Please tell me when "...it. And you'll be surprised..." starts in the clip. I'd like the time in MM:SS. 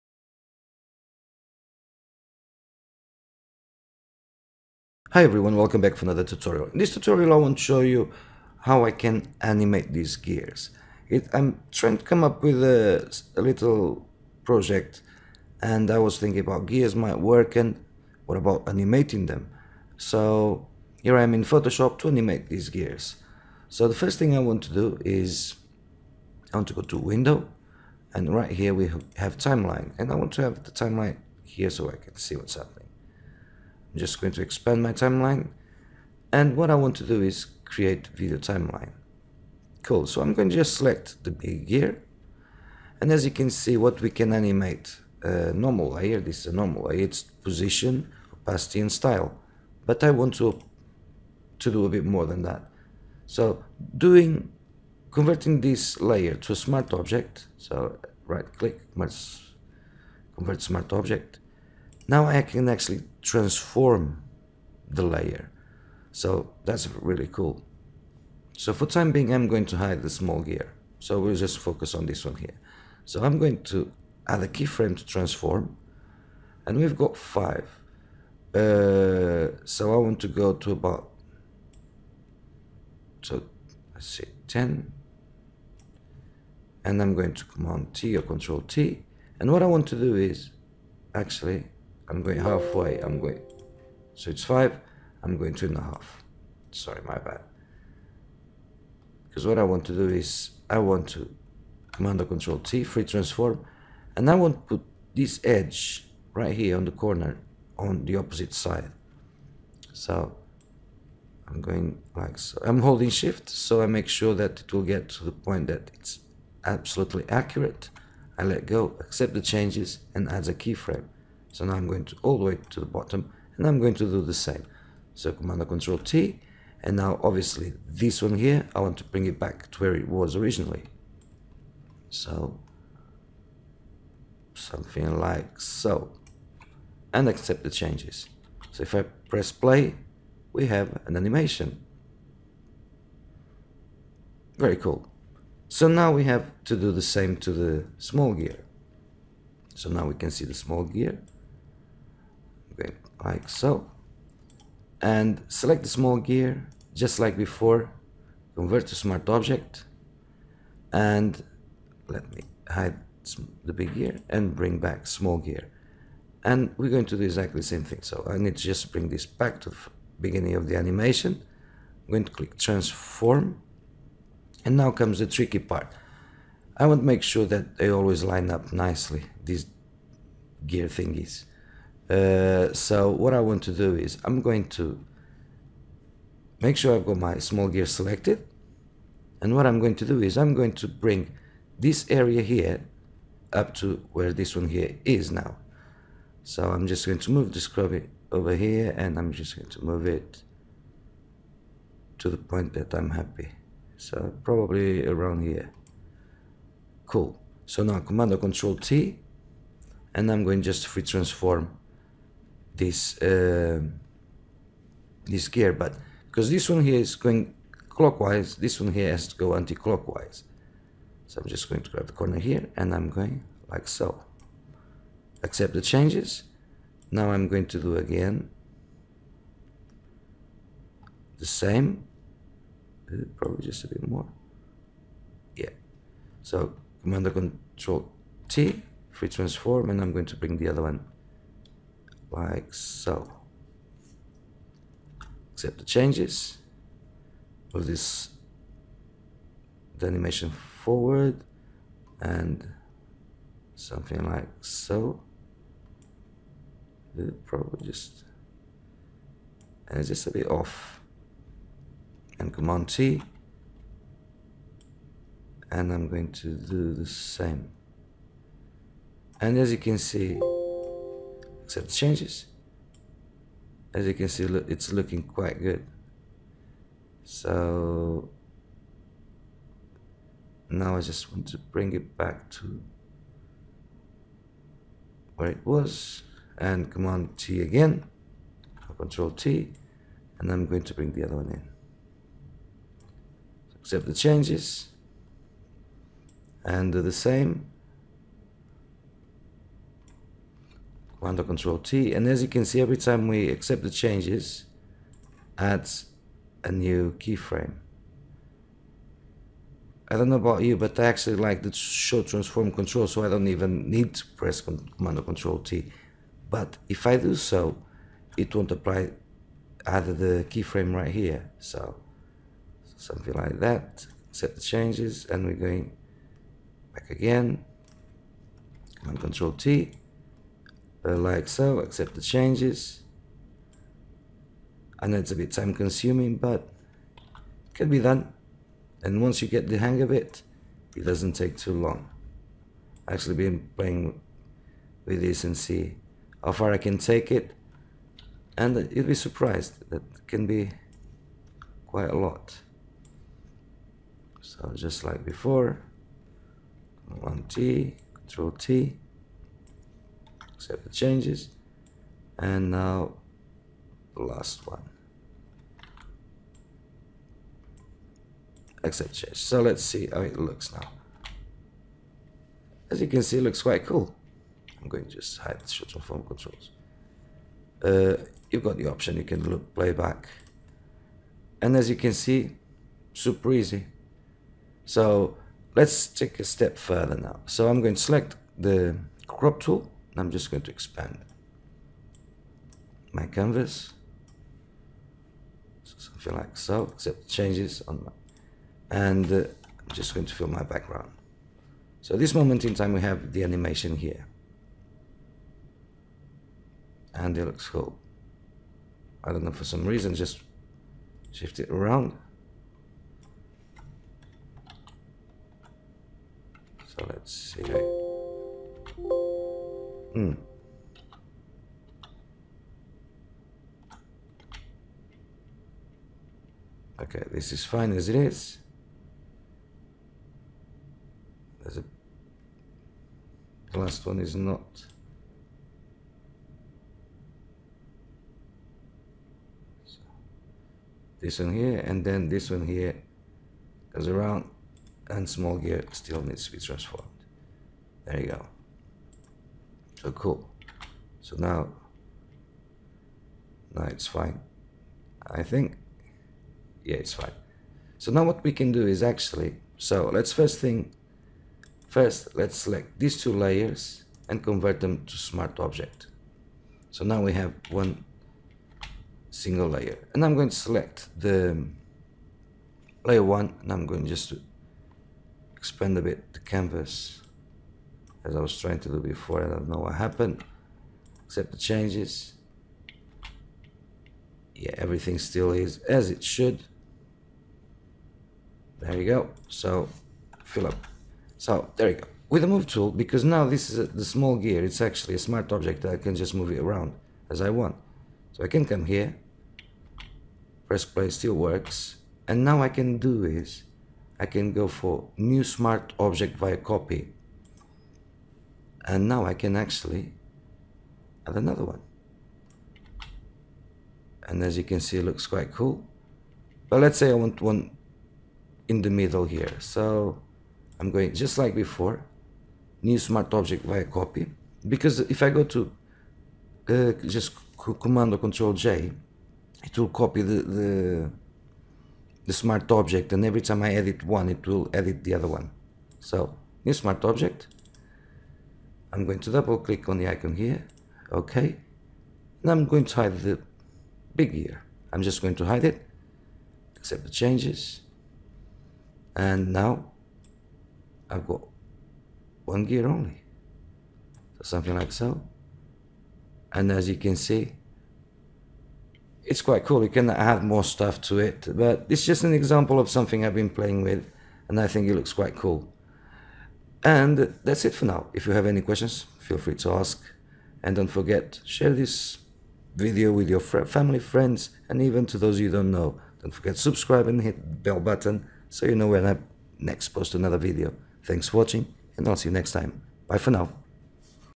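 05:47.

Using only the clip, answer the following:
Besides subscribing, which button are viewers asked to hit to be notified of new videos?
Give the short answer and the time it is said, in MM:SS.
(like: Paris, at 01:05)
Bell button, at 09:37.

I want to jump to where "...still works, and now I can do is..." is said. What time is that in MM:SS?
08:21.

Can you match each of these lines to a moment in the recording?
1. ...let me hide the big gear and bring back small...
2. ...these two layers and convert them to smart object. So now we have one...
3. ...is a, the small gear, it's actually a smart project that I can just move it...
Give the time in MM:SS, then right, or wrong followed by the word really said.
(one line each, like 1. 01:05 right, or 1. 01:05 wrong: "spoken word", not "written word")
1. 02:42 right
2. 07:42 right
3. 08:13 wrong: "object", not "project".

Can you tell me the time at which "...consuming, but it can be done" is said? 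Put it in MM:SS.
05:35.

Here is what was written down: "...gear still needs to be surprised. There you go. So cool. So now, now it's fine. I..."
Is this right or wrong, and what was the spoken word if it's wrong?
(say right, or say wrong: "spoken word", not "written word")
wrong: "transformed", not "surprised".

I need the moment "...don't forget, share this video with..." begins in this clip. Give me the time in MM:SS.
09:30.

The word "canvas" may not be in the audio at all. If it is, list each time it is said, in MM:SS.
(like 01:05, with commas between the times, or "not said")
06:33, 07:56.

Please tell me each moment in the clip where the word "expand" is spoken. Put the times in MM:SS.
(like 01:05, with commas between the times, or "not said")
00:34, 06:30, 07:55.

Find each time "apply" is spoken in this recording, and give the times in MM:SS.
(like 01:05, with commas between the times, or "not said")
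05:18.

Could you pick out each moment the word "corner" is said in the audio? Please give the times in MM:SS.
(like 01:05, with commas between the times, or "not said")
01:46, 03:42.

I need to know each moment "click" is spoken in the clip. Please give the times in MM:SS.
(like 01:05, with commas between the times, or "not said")
00:58, 02:52, 08:59.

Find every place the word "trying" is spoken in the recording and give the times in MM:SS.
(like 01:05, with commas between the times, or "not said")
00:11, 07:58.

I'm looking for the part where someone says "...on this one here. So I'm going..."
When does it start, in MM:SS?
01:11.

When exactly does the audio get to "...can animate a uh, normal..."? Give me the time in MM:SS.
00:44.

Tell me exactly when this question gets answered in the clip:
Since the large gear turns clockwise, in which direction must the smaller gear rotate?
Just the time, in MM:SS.
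03:39.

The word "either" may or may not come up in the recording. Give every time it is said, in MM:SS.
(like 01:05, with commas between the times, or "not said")
05:19.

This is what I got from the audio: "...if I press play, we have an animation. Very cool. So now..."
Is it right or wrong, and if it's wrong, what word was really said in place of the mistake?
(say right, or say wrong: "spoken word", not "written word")
right.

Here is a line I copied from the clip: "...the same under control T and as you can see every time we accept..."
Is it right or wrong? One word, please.
right.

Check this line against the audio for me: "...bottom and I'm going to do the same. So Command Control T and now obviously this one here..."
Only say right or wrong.
right.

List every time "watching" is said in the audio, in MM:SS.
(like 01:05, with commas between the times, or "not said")
09:41.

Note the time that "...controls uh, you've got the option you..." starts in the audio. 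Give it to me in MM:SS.
06:16.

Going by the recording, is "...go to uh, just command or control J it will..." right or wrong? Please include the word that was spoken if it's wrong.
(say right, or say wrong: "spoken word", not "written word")
right.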